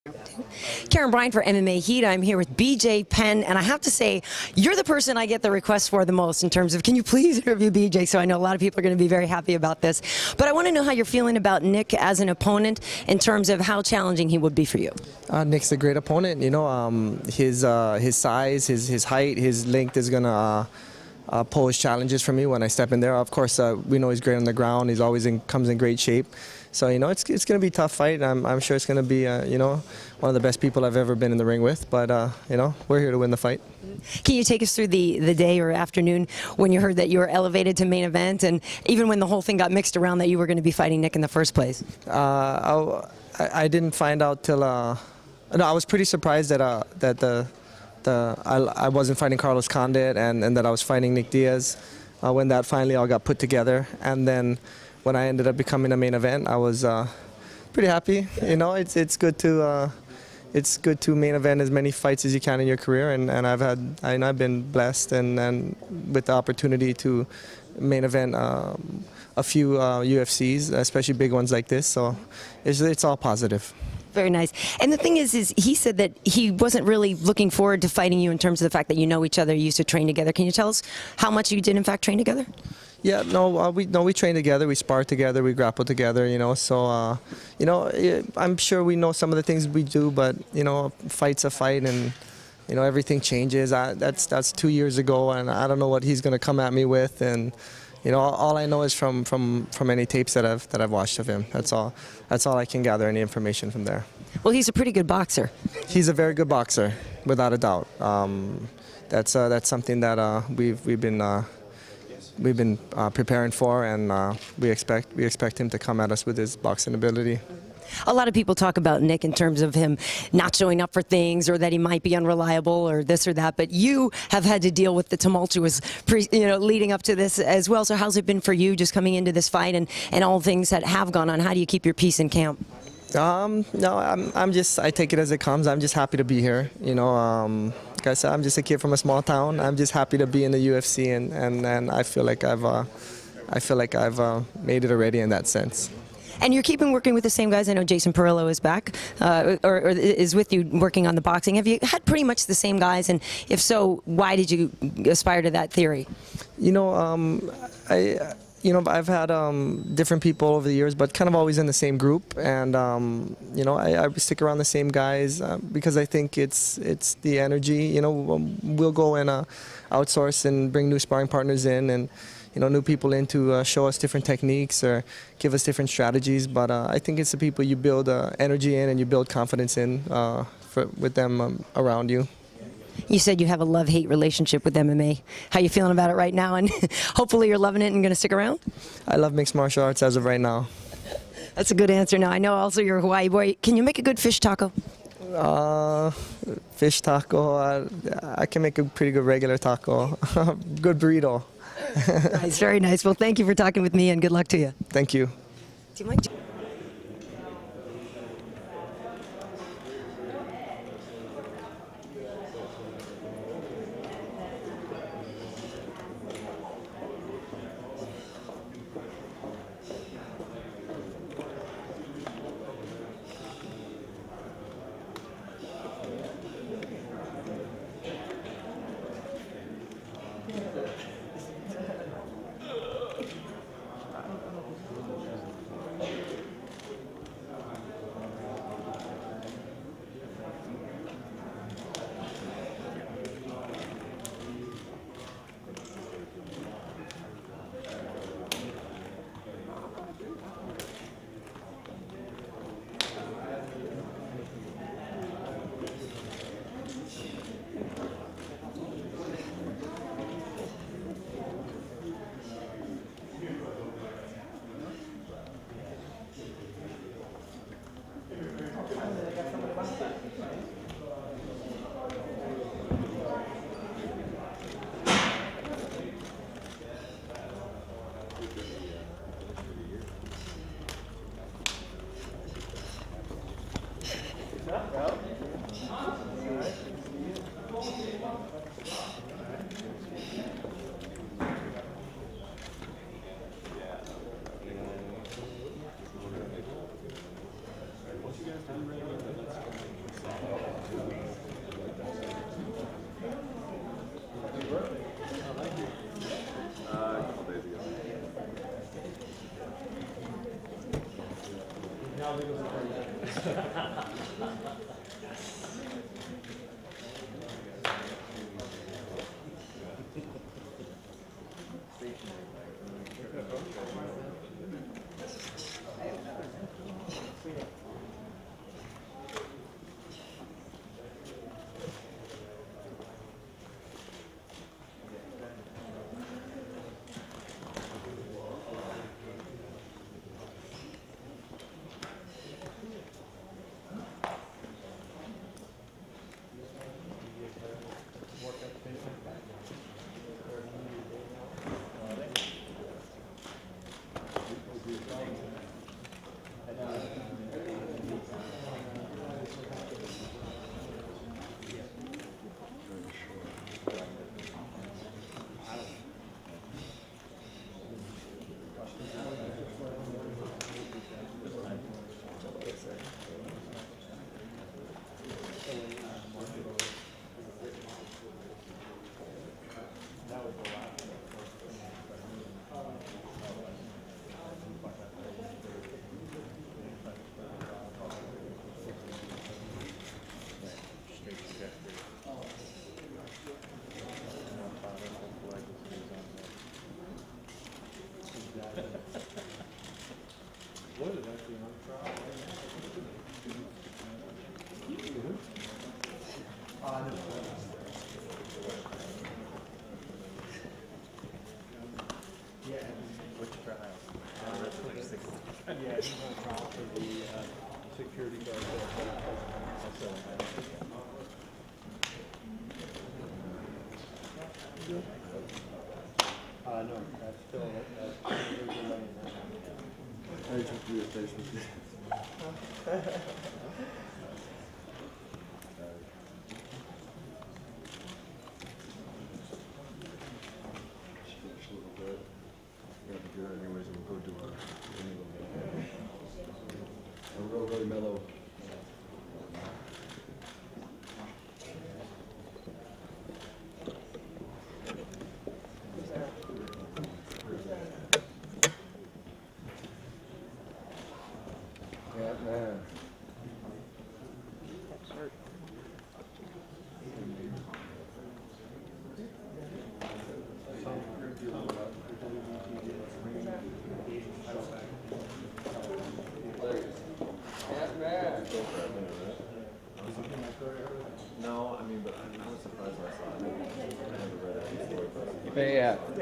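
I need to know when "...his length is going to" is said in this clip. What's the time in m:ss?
0:19.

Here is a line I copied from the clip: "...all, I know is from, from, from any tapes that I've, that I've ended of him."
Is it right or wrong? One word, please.
wrong.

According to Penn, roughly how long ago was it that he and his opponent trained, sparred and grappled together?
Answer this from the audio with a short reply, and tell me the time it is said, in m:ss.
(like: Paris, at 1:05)
2 years, at 1:34.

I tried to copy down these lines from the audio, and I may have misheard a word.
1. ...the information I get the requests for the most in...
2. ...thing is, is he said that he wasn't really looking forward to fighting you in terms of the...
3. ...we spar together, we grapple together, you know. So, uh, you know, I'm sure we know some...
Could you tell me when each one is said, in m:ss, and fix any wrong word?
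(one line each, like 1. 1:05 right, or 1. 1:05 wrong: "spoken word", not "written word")
1. 0:04 wrong: "person", not "information"
2. 1:14 right
3. 1:24 right.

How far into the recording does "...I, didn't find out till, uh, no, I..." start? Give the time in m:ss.
0:43.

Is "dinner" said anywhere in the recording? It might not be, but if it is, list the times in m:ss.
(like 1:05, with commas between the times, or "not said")
not said.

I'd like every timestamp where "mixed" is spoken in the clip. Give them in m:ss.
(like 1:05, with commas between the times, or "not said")
0:39, 3:09.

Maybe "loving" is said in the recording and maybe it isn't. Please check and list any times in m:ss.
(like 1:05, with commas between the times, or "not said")
3:07.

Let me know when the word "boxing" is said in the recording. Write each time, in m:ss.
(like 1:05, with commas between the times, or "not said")
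1:56, 2:31.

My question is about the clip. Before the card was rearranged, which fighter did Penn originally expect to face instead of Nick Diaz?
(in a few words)
Carlos Condit.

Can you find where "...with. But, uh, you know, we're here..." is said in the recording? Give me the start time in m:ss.
0:31.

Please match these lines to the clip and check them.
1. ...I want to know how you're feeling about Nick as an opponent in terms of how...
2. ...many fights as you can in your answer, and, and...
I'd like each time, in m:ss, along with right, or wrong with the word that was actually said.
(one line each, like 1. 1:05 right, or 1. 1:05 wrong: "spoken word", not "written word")
1. 0:10 right
2. 1:01 wrong: "career", not "answer".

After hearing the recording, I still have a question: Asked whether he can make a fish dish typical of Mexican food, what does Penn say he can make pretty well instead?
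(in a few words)
regular taco.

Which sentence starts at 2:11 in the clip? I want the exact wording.
How do you keep your peace in camp?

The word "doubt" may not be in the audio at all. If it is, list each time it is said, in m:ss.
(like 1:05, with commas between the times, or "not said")
1:47.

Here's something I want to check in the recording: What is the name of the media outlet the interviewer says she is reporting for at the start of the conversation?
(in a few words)
MMA Heat.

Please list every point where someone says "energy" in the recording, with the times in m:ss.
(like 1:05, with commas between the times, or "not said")
2:47, 2:58.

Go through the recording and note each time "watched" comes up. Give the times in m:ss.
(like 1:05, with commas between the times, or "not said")
1:40.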